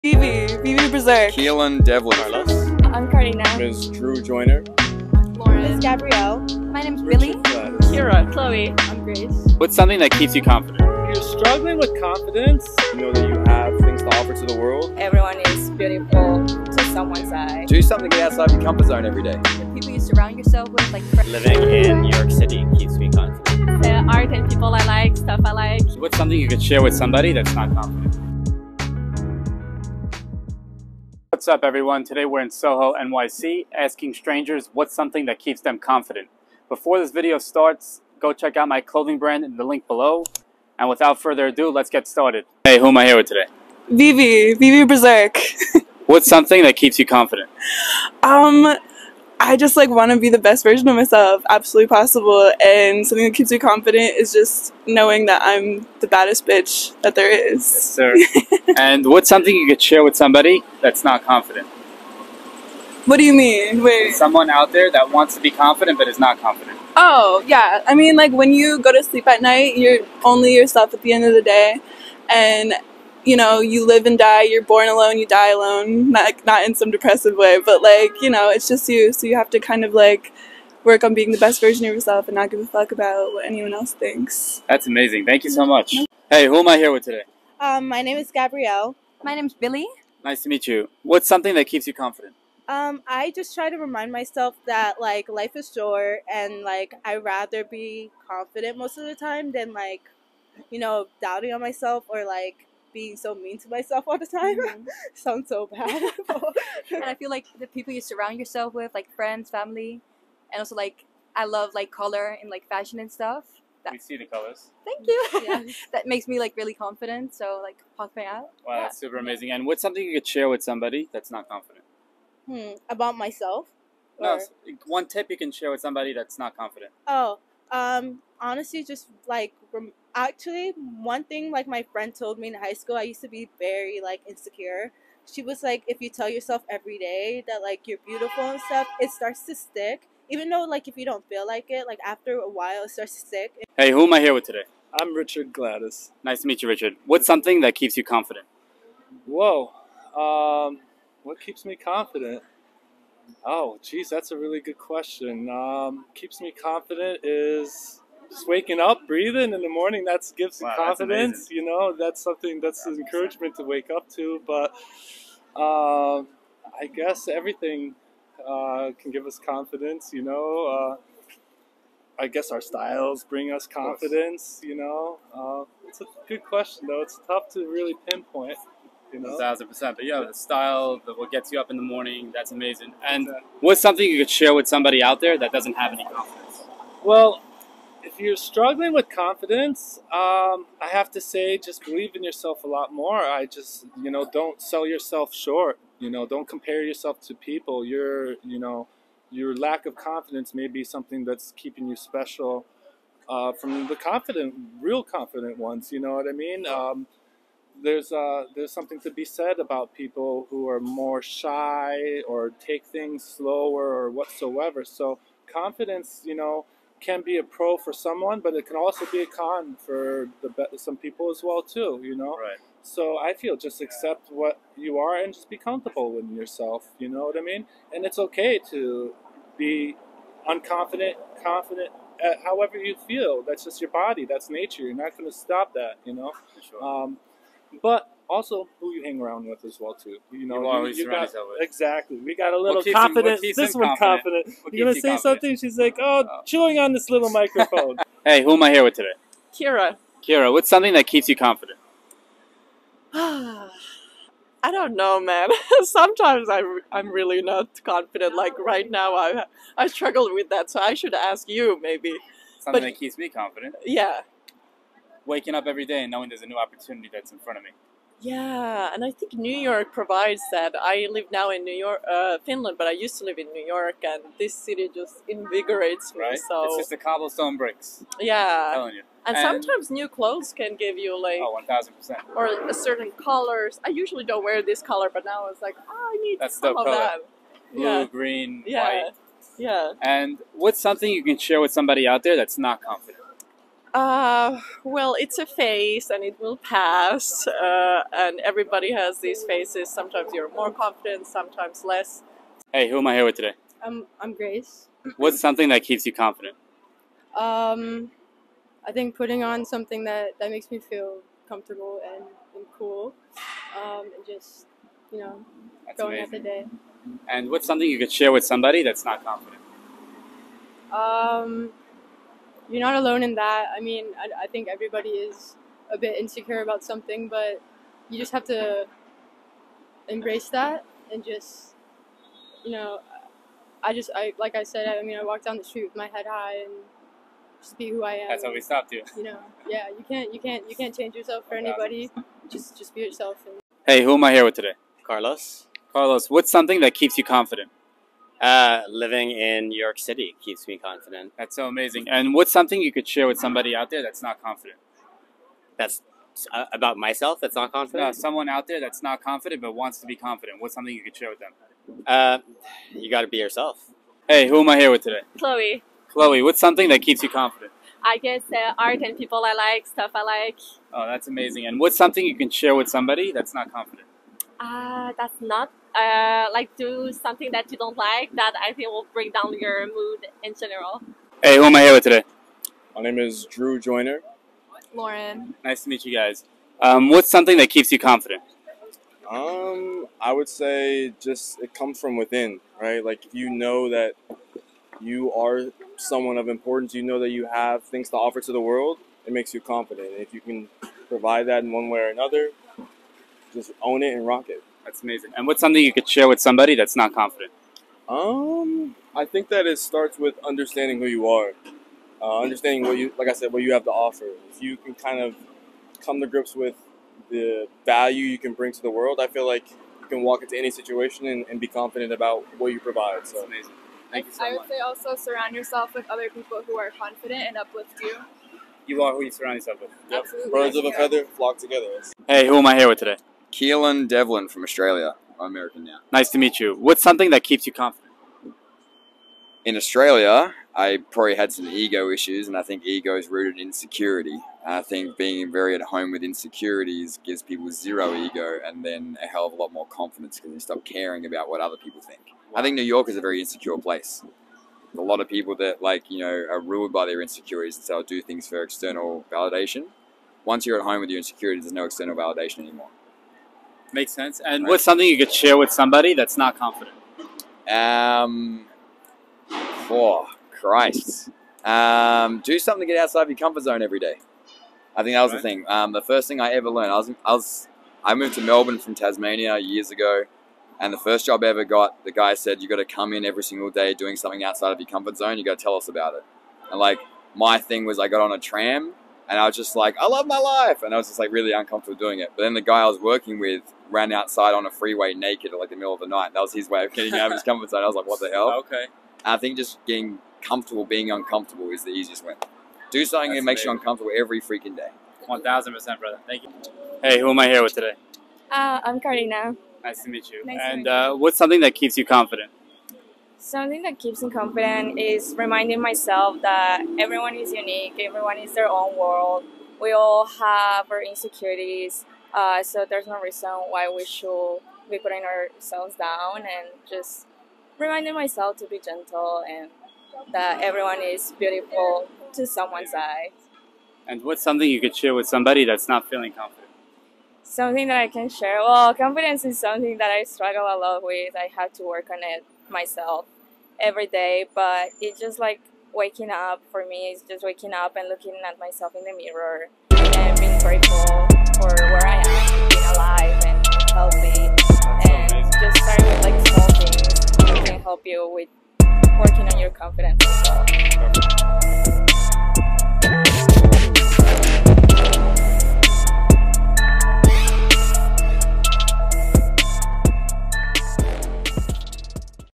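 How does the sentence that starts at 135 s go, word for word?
She was like, if you tell yourself every day that like you're beautiful and stuff, it starts to stick.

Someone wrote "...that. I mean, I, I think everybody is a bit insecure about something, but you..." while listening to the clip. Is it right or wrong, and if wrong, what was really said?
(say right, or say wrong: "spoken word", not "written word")
right.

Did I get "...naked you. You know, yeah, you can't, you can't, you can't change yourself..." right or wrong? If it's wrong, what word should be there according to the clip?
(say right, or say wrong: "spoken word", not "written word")
wrong: "stopped", not "naked".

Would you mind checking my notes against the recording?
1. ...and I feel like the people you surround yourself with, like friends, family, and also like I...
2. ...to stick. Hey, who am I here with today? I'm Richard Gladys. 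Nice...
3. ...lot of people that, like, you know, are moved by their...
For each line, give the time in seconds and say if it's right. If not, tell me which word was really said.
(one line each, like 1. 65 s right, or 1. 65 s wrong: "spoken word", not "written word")
1. 106 s right
2. 143 s right
3. 455 s wrong: "ruled", not "moved".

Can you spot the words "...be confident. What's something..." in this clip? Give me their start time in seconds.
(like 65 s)
360 s.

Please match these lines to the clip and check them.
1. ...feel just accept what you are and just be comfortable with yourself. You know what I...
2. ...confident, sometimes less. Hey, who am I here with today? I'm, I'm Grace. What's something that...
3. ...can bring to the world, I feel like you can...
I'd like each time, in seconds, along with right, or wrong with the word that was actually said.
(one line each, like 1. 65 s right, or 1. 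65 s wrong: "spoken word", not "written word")
1. 223 s right
2. 300 s right
3. 418 s right.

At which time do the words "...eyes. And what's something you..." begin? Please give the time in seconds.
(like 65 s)
532 s.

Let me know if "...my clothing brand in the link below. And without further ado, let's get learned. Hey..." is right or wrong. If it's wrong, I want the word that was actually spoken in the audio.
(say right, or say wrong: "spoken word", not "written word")
wrong: "started", not "learned".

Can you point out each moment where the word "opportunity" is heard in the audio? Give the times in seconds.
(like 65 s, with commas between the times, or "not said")
266 s.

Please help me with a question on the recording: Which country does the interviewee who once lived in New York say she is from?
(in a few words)
Finland.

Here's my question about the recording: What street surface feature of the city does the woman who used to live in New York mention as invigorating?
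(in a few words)
cobblestone bricks.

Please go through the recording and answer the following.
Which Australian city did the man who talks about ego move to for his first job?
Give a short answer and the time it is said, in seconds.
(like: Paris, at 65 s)
Melbourne, at 478 s.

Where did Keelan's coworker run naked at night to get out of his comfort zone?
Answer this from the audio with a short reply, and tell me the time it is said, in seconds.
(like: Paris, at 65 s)
a freeway, at 494 s.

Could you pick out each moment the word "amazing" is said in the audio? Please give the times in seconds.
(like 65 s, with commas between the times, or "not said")
84 s, 119 s, 182 s, 351 s, 371 s, 405 s, 423 s.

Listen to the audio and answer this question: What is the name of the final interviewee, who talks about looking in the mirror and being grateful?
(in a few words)
Karina.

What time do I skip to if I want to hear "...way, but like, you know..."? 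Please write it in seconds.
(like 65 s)
77 s.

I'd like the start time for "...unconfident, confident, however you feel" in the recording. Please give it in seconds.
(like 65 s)
230 s.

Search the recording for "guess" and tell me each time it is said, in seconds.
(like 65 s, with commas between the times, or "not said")
166 s, 172 s, 368 s.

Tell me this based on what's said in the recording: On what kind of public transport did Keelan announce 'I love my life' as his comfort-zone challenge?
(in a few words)
tram.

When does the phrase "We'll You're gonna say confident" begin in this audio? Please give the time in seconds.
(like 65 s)
244 s.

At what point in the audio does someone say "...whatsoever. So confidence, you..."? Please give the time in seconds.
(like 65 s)
214 s.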